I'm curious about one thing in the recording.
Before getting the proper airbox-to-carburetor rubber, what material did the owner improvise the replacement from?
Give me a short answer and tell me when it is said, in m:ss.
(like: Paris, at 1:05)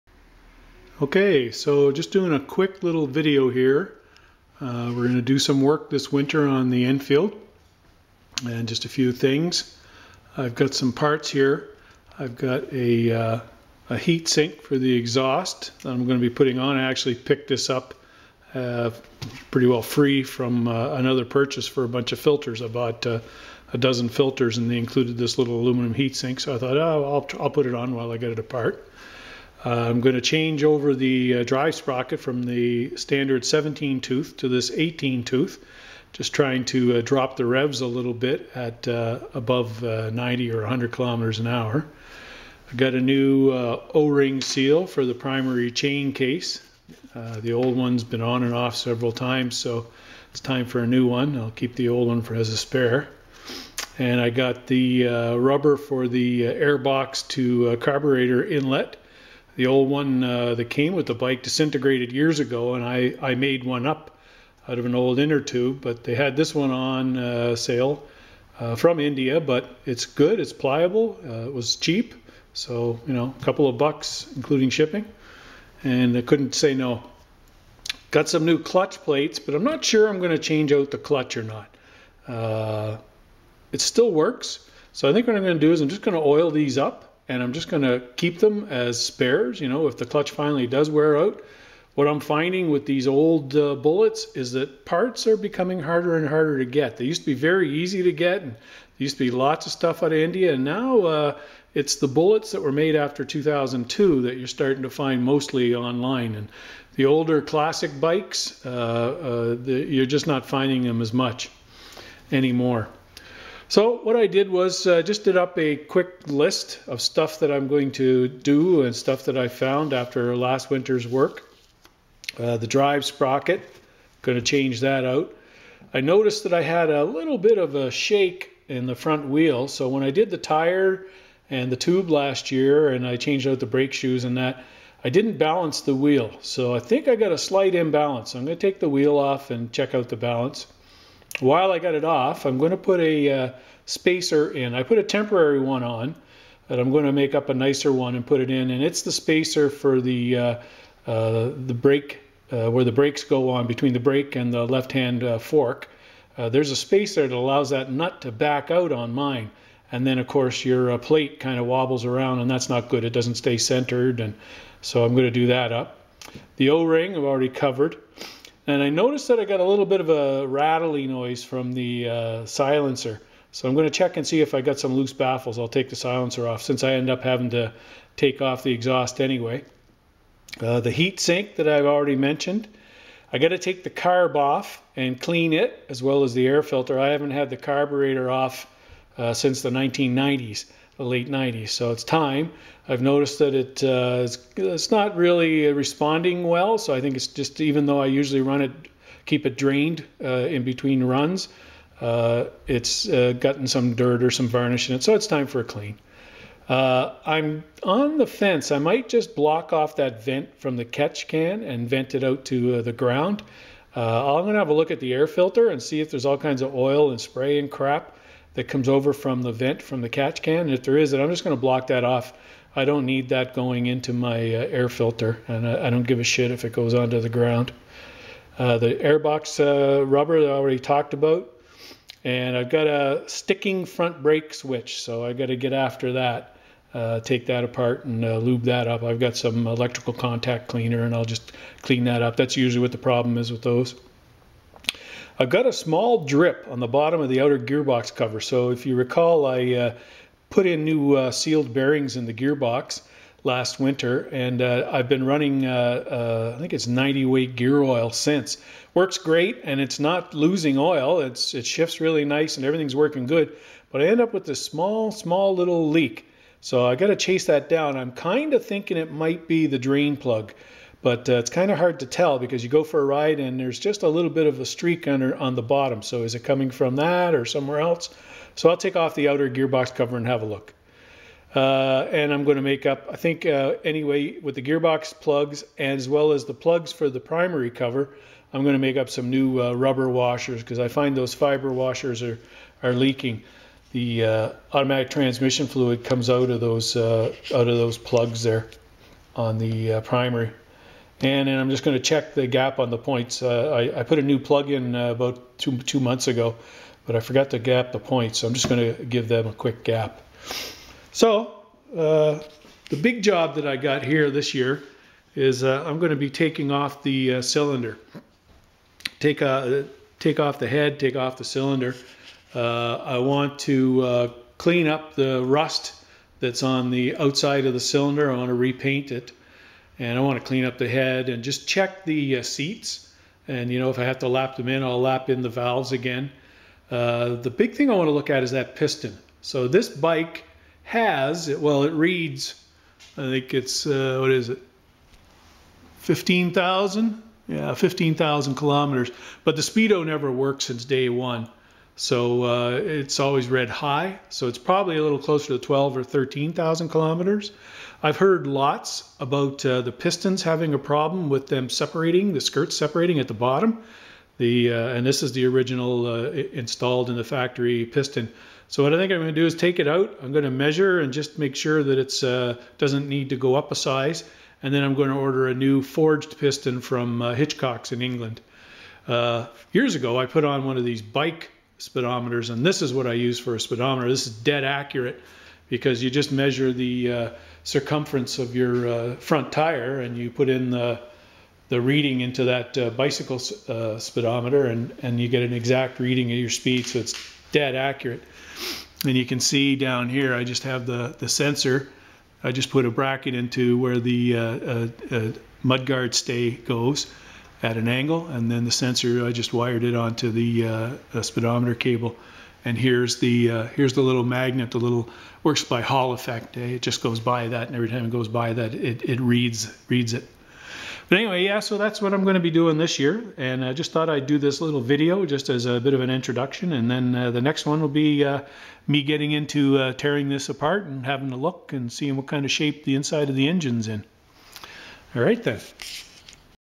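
An old inner tube, at 1:04.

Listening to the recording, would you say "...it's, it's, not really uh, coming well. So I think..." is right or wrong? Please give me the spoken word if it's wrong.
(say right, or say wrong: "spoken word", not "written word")
wrong: "responding", not "coming".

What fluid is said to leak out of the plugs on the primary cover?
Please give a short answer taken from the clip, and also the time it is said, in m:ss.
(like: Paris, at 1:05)
Automatic transmission fluid, at 4:54.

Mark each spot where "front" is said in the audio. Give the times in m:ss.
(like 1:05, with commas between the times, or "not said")
2:08, 3:53, 6:29.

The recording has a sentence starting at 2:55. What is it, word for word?
I'll take the silencer off since I end up having to take off the exhaust anyway.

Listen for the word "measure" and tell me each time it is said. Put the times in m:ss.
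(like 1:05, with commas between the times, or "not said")
6:10, 6:26.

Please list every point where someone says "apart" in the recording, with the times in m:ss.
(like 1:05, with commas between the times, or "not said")
0:28, 3:57, 7:10.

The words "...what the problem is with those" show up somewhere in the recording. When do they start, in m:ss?
4:02.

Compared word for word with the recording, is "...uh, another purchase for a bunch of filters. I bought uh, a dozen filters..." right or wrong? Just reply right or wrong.
right.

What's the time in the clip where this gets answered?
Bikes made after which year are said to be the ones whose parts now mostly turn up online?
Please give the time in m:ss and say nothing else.
1:43.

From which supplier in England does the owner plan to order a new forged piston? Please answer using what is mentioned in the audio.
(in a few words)
Hitchcock's.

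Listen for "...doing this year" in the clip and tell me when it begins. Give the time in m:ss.
7:02.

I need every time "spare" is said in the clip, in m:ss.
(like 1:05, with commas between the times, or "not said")
0:52, 1:29.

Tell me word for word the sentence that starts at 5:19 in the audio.
Take, a, take off the head, take off the cylinder.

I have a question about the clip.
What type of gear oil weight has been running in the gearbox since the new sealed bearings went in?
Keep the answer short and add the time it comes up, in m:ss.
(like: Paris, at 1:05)
90 weight, at 4:16.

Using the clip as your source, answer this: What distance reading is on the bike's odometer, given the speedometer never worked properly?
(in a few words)
15,000 kilometers.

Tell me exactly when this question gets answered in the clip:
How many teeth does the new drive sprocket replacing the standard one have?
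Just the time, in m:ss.
0:34.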